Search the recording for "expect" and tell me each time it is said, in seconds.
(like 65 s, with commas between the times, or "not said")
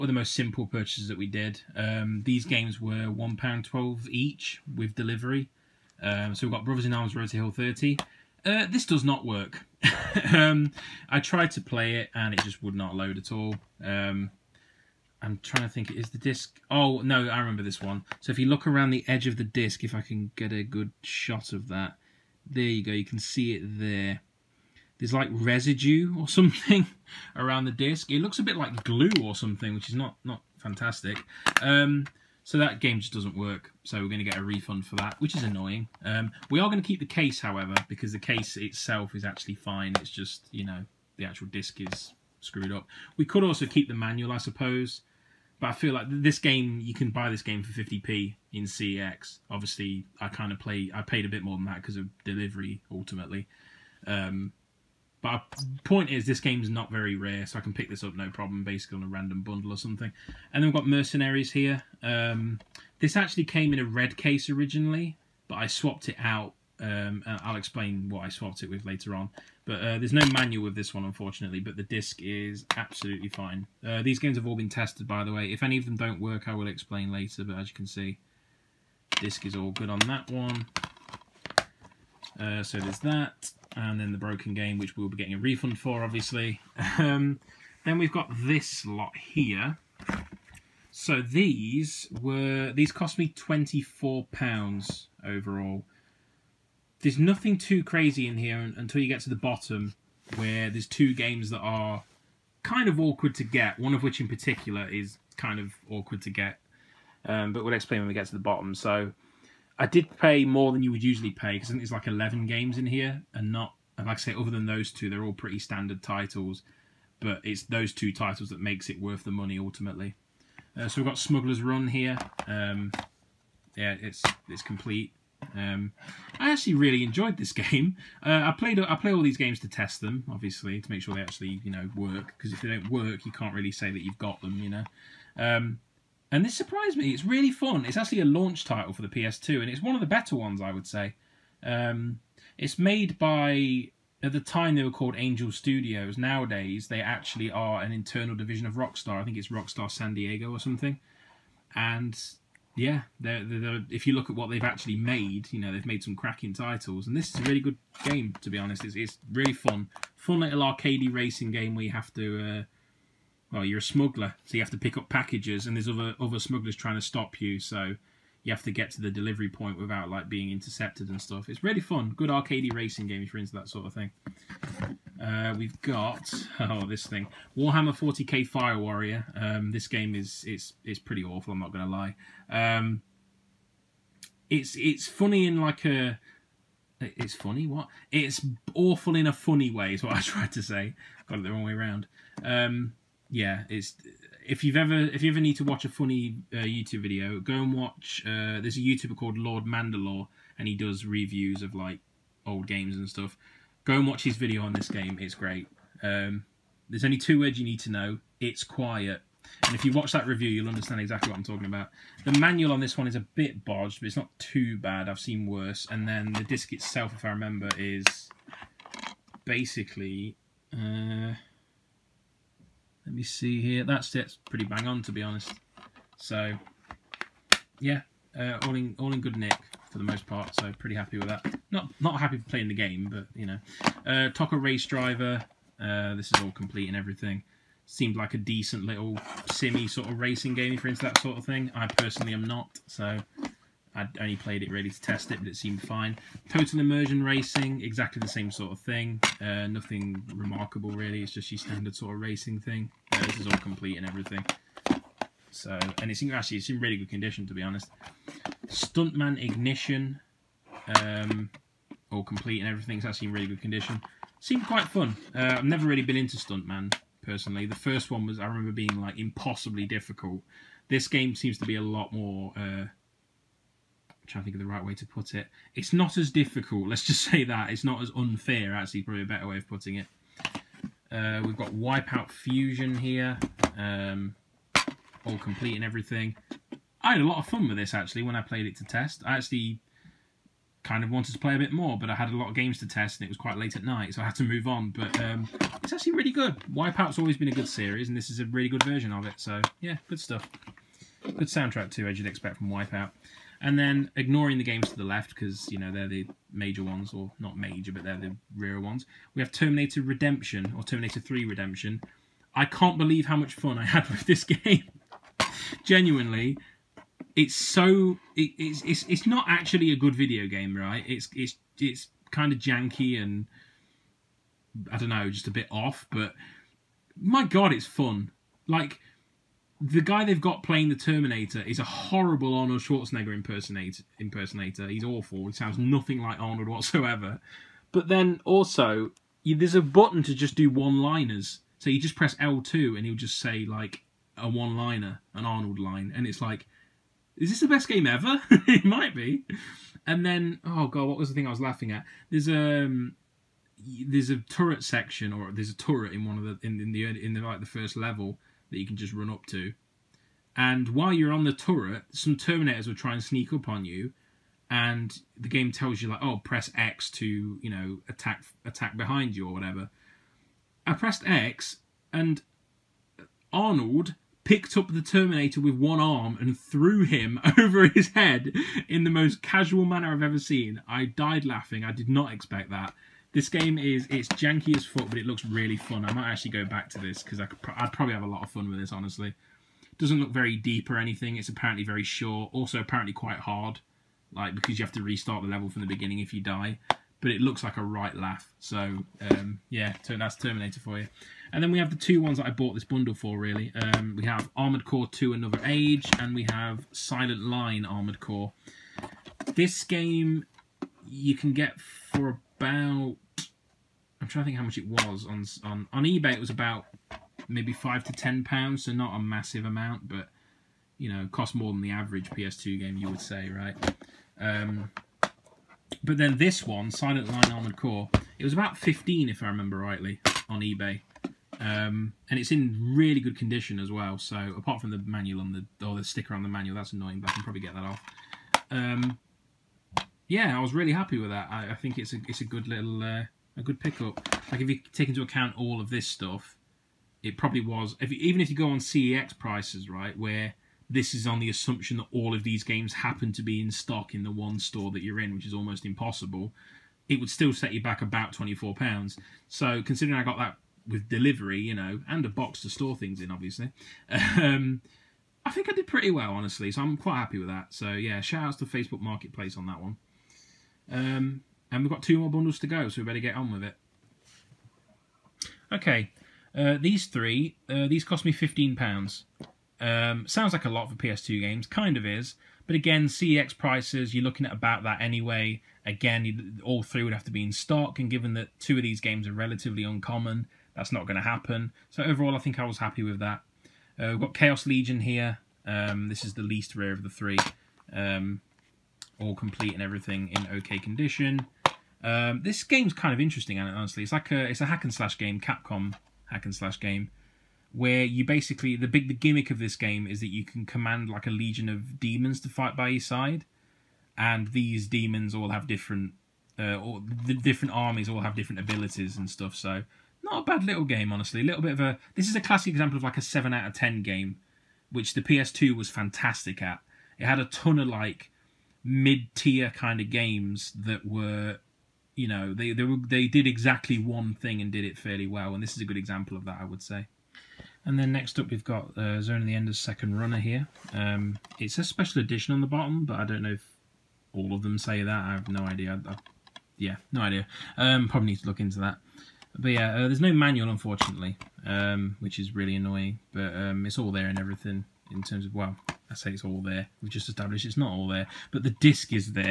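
302 s, 382 s.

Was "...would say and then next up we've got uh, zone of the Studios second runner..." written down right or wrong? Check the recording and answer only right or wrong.
wrong.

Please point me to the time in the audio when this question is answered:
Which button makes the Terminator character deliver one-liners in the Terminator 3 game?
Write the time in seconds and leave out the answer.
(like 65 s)
342 s.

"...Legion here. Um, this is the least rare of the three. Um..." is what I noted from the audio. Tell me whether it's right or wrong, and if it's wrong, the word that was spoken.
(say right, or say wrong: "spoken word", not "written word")
right.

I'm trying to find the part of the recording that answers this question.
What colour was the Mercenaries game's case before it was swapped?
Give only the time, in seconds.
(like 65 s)
63 s.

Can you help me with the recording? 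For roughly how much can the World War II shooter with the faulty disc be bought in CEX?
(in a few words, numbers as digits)
50p.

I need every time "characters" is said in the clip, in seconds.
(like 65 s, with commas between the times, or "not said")
not said.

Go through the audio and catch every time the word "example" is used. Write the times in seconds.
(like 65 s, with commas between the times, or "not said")
522 s, 535 s.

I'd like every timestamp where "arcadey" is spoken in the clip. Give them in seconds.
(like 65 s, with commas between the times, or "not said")
160 s, 172 s.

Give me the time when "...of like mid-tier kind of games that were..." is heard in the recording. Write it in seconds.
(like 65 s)
527 s.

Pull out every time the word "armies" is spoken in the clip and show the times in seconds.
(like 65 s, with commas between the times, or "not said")
517 s.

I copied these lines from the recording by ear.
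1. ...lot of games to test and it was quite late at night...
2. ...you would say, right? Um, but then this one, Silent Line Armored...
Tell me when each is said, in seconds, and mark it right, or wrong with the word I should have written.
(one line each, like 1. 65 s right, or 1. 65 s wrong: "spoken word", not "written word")
1. 292 s right
2. 422 s right.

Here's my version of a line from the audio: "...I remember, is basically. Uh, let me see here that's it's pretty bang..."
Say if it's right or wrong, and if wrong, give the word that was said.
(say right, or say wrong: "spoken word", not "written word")
right.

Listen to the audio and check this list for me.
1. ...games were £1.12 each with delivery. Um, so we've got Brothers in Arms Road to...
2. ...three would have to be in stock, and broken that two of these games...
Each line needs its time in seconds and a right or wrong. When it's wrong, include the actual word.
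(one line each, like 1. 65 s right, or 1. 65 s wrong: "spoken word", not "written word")
1. 2 s right
2. 486 s wrong: "given", not "broken".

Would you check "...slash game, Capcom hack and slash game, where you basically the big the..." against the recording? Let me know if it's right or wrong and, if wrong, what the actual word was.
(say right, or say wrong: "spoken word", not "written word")
right.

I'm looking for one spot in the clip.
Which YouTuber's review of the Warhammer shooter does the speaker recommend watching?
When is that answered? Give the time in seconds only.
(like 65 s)
199 s.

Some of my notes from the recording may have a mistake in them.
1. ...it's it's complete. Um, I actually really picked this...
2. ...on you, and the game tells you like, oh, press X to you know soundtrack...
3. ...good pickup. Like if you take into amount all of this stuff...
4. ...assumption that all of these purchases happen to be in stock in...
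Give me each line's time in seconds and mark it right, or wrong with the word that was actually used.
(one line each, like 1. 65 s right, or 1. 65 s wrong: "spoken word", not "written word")
1. 124 s wrong: "enjoyed", not "picked"
2. 363 s wrong: "attack", not "soundtrack"
3. 443 s wrong: "account", not "amount"
4. 451 s wrong: "games", not "purchases".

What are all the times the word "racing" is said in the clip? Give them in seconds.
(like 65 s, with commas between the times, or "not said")
161 s, 172 s, 240 s, 247 s, 252 s.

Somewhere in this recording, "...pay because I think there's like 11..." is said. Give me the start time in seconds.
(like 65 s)
111 s.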